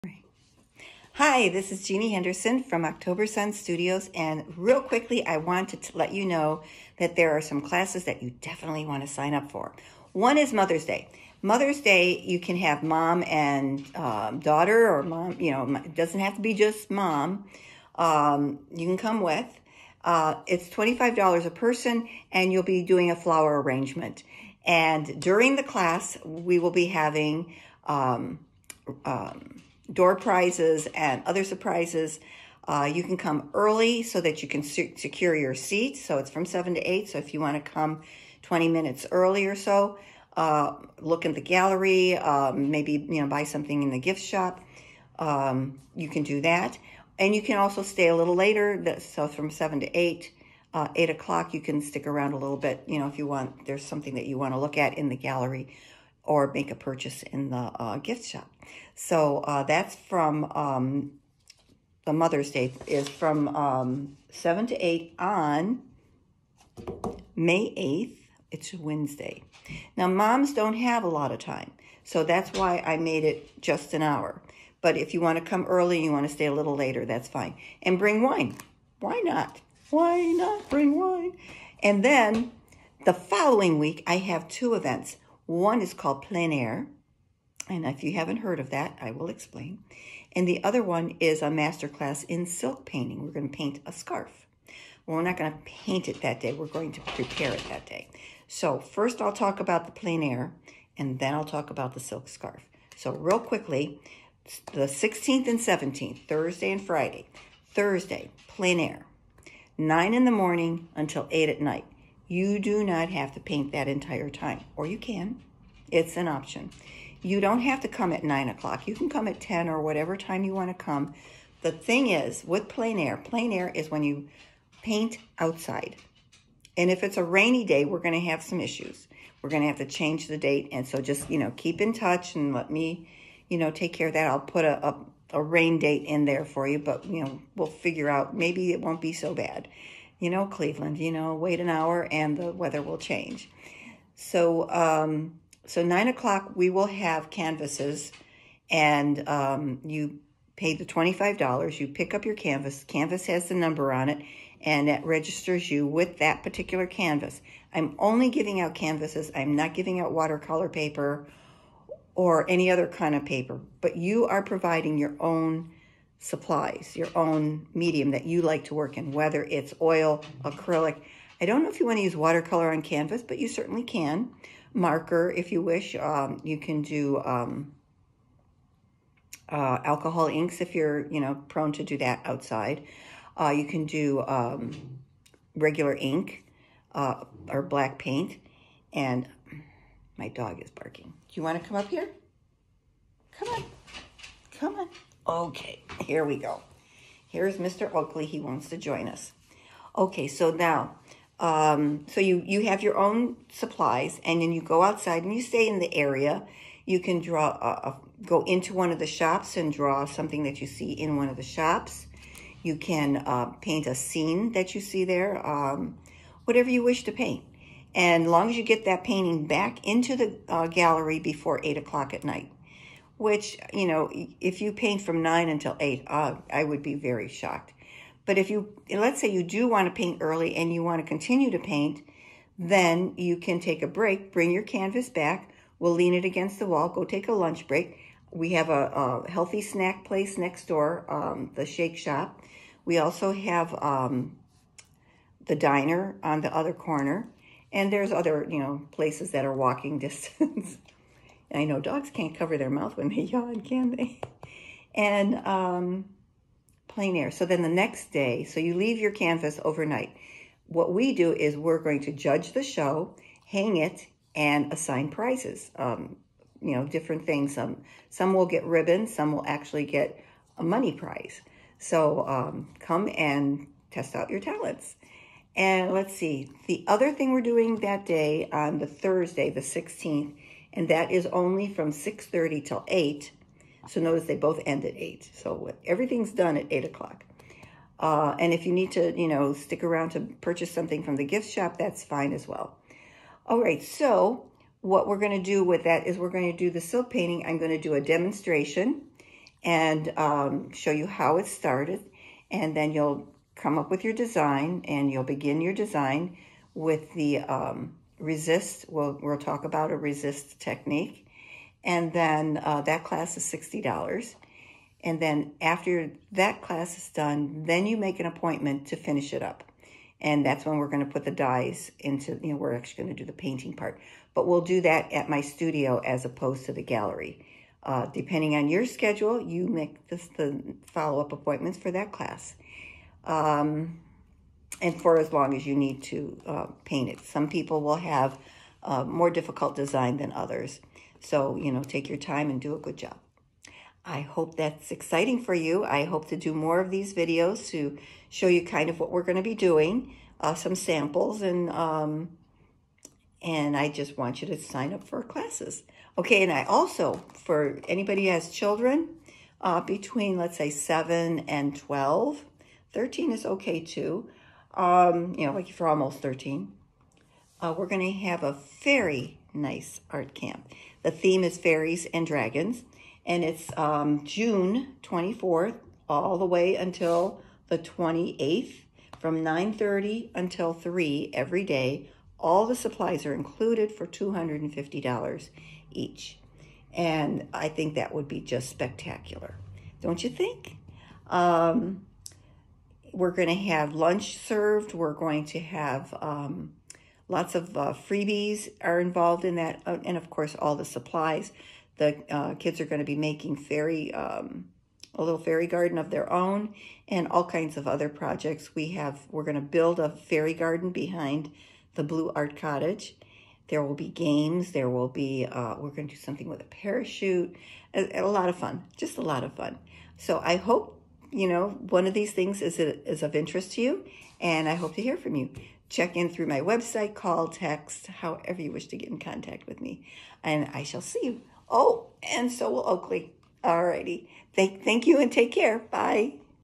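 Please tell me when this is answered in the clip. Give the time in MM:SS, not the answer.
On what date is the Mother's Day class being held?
01:07.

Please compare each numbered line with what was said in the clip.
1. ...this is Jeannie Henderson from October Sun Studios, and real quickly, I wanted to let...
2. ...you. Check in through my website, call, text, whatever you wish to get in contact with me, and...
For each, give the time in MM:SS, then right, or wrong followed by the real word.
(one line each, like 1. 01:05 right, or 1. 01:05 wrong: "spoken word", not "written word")
1. 00:01 right
2. 07:05 wrong: "however", not "whatever".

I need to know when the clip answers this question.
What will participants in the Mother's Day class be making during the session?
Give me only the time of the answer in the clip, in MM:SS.
00:23.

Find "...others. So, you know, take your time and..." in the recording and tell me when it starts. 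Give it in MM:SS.
05:40.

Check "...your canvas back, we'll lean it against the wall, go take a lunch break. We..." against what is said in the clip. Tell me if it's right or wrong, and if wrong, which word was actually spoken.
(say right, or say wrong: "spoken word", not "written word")
right.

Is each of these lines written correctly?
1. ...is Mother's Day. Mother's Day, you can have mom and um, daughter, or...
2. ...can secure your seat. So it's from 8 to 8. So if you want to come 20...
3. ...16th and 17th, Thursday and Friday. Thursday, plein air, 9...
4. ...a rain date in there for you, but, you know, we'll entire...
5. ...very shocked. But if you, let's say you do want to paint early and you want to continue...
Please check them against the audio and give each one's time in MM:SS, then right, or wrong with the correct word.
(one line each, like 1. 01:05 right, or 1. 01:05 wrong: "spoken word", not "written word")
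1. 00:10 right
2. 00:34 wrong: "7", not "8"
3. 01:44 right
4. 02:15 wrong: "figure", not "entire"
5. 03:46 right.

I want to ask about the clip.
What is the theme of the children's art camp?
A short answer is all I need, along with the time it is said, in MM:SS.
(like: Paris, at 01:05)
fairies and dragons, at 06:11.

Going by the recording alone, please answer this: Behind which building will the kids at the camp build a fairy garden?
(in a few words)
the Blue Art Cottage.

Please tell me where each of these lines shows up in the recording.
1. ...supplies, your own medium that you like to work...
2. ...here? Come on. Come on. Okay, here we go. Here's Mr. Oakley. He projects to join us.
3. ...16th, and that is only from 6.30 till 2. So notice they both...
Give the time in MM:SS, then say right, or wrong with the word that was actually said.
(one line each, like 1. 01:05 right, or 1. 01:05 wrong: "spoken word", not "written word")
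1. 02:46 right
2. 03:11 wrong: "wants", not "projects"
3. 04:39 wrong: "8", not "2".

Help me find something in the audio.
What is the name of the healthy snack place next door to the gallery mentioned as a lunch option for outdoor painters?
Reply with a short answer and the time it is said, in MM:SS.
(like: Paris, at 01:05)
the Shake Shop, at 04:01.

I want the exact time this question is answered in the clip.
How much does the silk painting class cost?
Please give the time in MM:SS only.
05:13.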